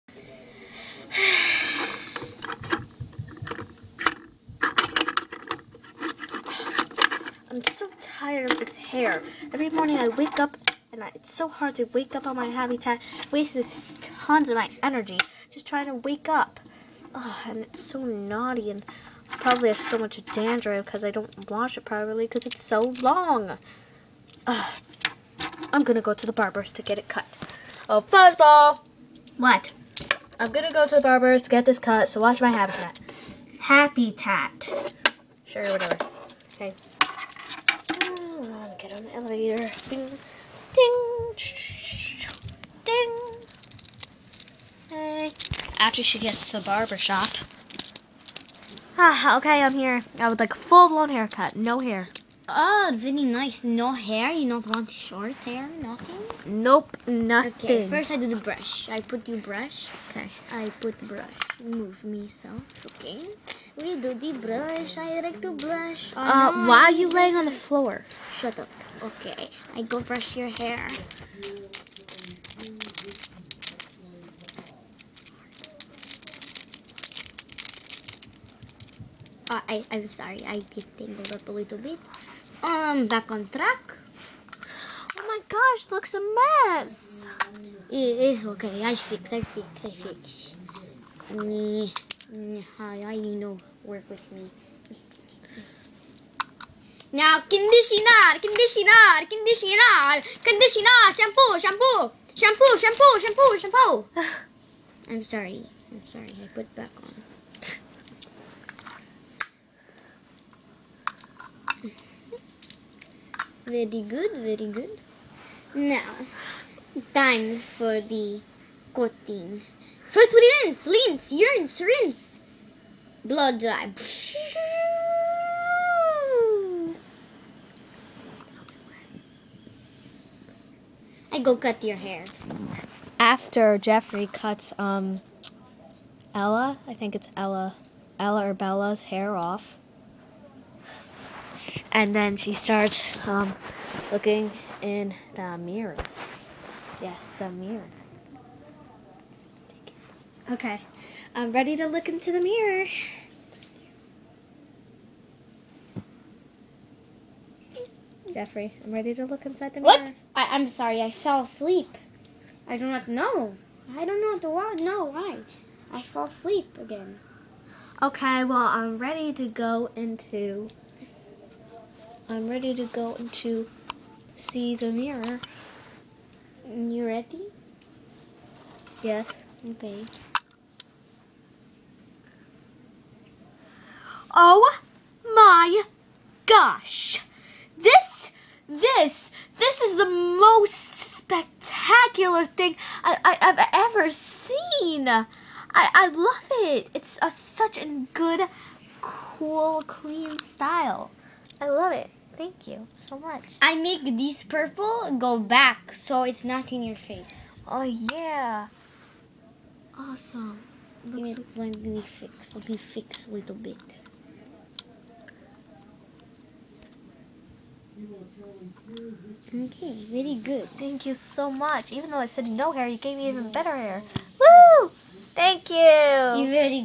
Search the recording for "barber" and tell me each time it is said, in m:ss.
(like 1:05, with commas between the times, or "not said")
0:26, 0:31, 0:46.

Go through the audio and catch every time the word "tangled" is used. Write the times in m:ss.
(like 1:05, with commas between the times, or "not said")
1:20.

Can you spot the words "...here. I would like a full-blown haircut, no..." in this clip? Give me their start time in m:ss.
0:49.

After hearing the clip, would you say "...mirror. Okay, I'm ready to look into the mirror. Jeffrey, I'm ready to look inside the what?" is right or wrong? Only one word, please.
right.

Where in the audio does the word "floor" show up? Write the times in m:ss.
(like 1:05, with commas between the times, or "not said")
1:07.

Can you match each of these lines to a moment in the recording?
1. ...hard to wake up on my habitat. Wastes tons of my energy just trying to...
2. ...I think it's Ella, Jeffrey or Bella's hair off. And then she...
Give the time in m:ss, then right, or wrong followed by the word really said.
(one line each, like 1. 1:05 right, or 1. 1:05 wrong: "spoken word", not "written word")
1. 0:11 right
2. 2:16 wrong: "Ella", not "Jeffrey".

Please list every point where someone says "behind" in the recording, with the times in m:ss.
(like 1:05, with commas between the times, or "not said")
not said.